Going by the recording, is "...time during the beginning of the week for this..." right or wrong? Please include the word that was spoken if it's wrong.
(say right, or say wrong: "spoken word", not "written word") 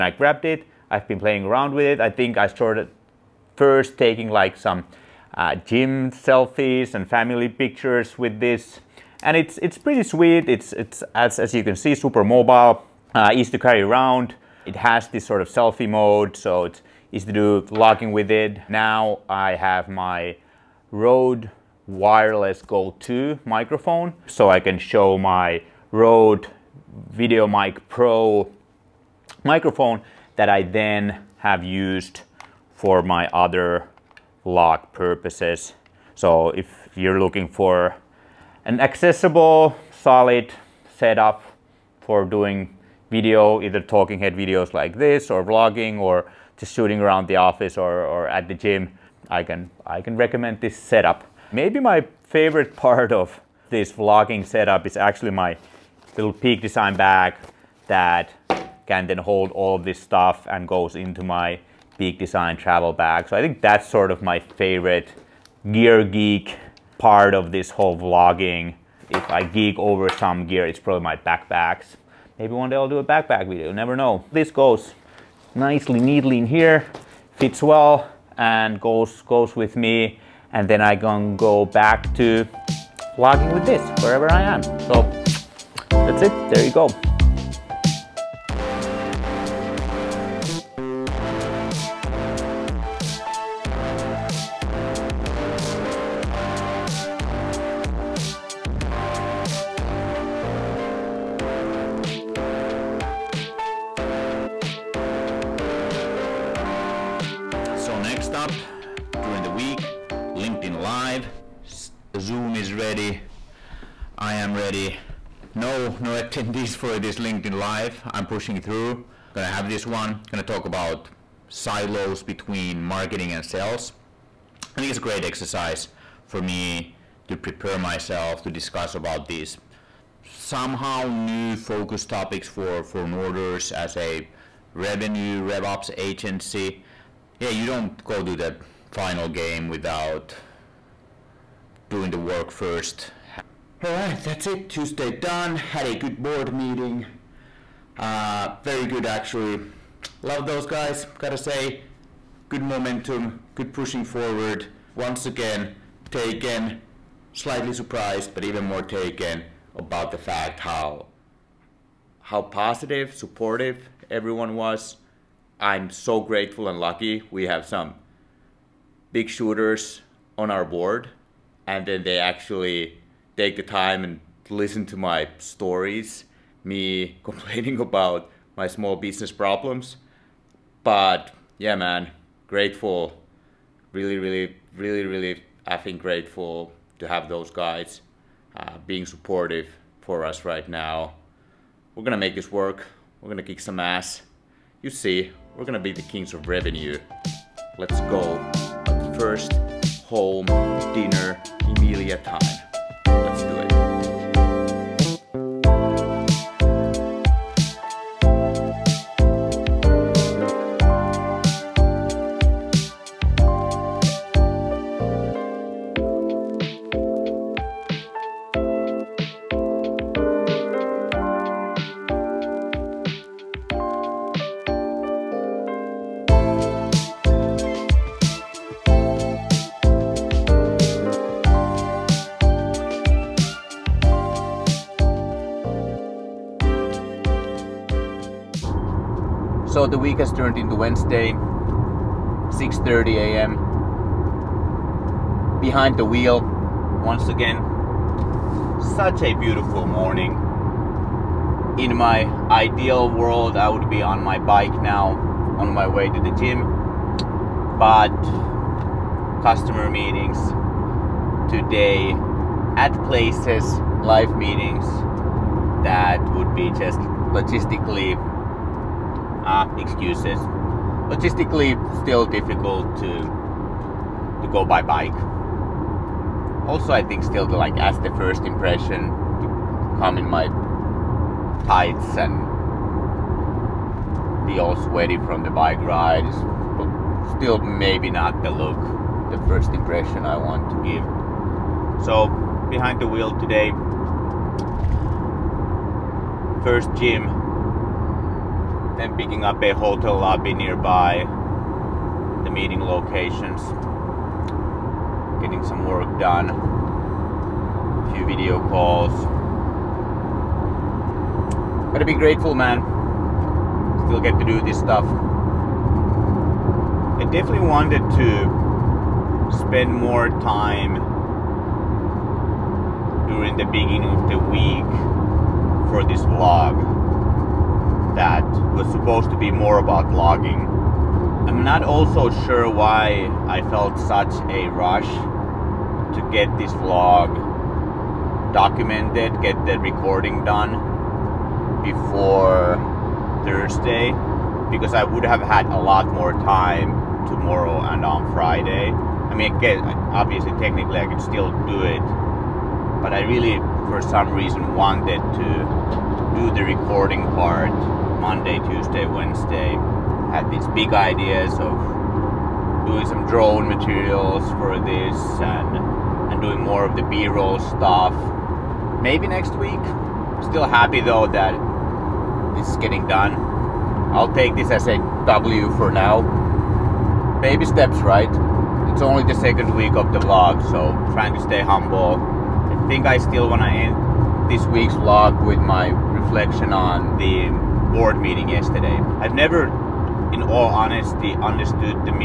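right.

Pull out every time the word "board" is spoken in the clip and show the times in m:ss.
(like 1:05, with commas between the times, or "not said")
2:26, 2:50, 6:27.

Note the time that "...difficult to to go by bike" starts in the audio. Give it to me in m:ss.
4:32.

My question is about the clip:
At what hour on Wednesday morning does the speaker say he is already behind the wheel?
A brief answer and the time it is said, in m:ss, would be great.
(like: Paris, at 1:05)
6:30 a.m., at 4:02.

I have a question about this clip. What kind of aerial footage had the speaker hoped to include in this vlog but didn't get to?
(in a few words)
drone materials.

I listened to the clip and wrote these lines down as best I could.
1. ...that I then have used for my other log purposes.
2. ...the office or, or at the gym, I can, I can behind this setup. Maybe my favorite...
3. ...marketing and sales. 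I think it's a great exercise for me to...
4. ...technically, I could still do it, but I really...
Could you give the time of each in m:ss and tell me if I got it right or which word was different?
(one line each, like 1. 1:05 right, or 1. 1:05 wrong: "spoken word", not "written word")
1. 0:30 right
2. 0:47 wrong: "recommend", not "behind"
3. 2:02 right
4. 5:50 right.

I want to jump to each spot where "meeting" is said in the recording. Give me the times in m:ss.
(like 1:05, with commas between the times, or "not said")
2:26, 4:19, 4:24, 5:02, 6:28.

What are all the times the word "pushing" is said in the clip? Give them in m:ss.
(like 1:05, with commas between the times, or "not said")
1:58, 2:33.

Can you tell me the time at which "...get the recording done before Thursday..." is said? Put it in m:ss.
5:39.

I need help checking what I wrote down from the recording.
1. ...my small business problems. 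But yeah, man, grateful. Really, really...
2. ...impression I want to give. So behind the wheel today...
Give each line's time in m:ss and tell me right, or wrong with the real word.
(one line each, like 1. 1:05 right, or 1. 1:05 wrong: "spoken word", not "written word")
1. 2:58 right
2. 4:49 right.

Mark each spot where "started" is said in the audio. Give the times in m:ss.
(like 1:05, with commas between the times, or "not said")
0:02.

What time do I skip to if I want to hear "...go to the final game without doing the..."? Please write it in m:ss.
2:18.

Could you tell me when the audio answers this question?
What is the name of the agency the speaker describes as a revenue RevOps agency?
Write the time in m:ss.
2:13.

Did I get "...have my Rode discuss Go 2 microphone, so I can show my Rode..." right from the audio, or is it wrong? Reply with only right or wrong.
wrong.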